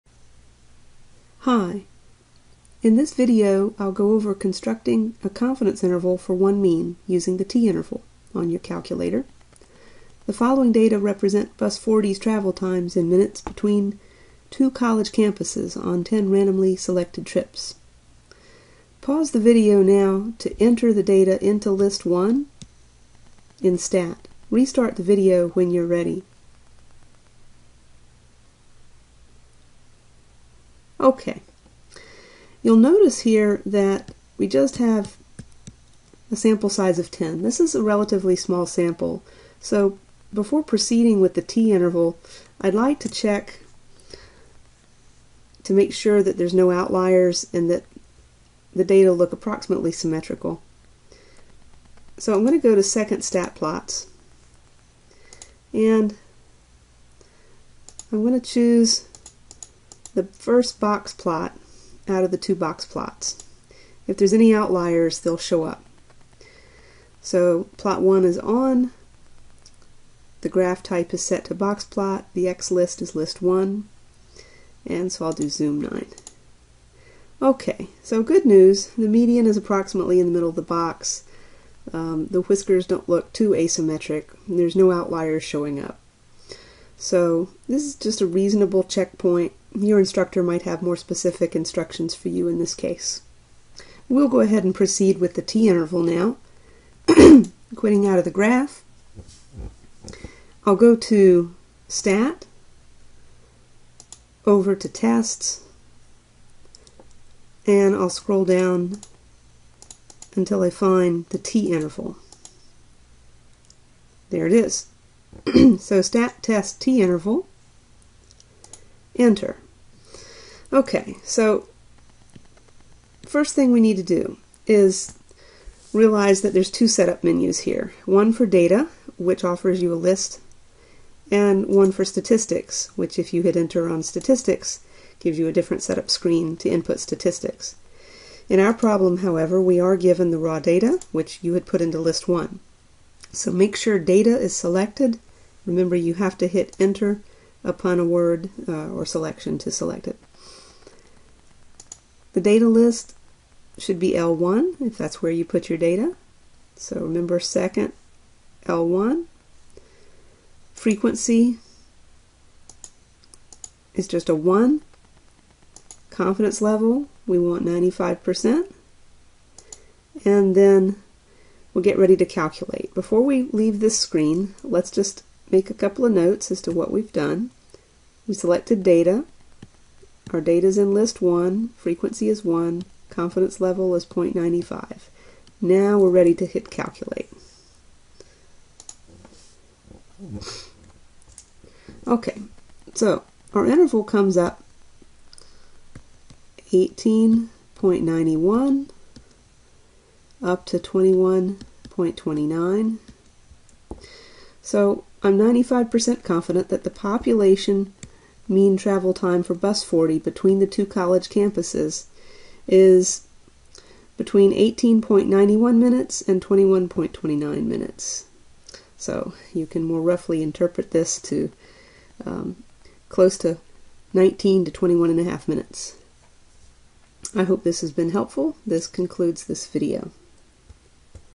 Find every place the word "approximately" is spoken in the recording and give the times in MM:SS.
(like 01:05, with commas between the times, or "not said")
00:49, 01:19.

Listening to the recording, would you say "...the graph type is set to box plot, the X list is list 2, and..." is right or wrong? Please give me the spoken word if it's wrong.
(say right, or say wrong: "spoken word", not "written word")
wrong: "1", not "2".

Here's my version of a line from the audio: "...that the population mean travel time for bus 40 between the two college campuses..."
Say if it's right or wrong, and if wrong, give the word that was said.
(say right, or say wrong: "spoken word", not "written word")
right.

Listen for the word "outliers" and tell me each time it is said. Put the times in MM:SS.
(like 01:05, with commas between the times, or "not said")
00:46, 01:04, 01:24.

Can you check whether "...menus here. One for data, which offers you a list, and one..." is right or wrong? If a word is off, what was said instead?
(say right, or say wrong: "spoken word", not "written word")
right.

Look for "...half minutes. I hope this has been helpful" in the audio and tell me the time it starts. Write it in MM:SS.
03:45.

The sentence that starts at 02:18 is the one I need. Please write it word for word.
In our problem, however, we are given the raw data, which you had put into list 1.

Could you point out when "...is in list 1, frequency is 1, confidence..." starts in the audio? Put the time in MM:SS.
03:00.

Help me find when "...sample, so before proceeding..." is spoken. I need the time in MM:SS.
00:38.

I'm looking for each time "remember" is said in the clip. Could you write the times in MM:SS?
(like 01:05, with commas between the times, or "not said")
02:25, 02:37.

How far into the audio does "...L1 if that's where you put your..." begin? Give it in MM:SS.
02:34.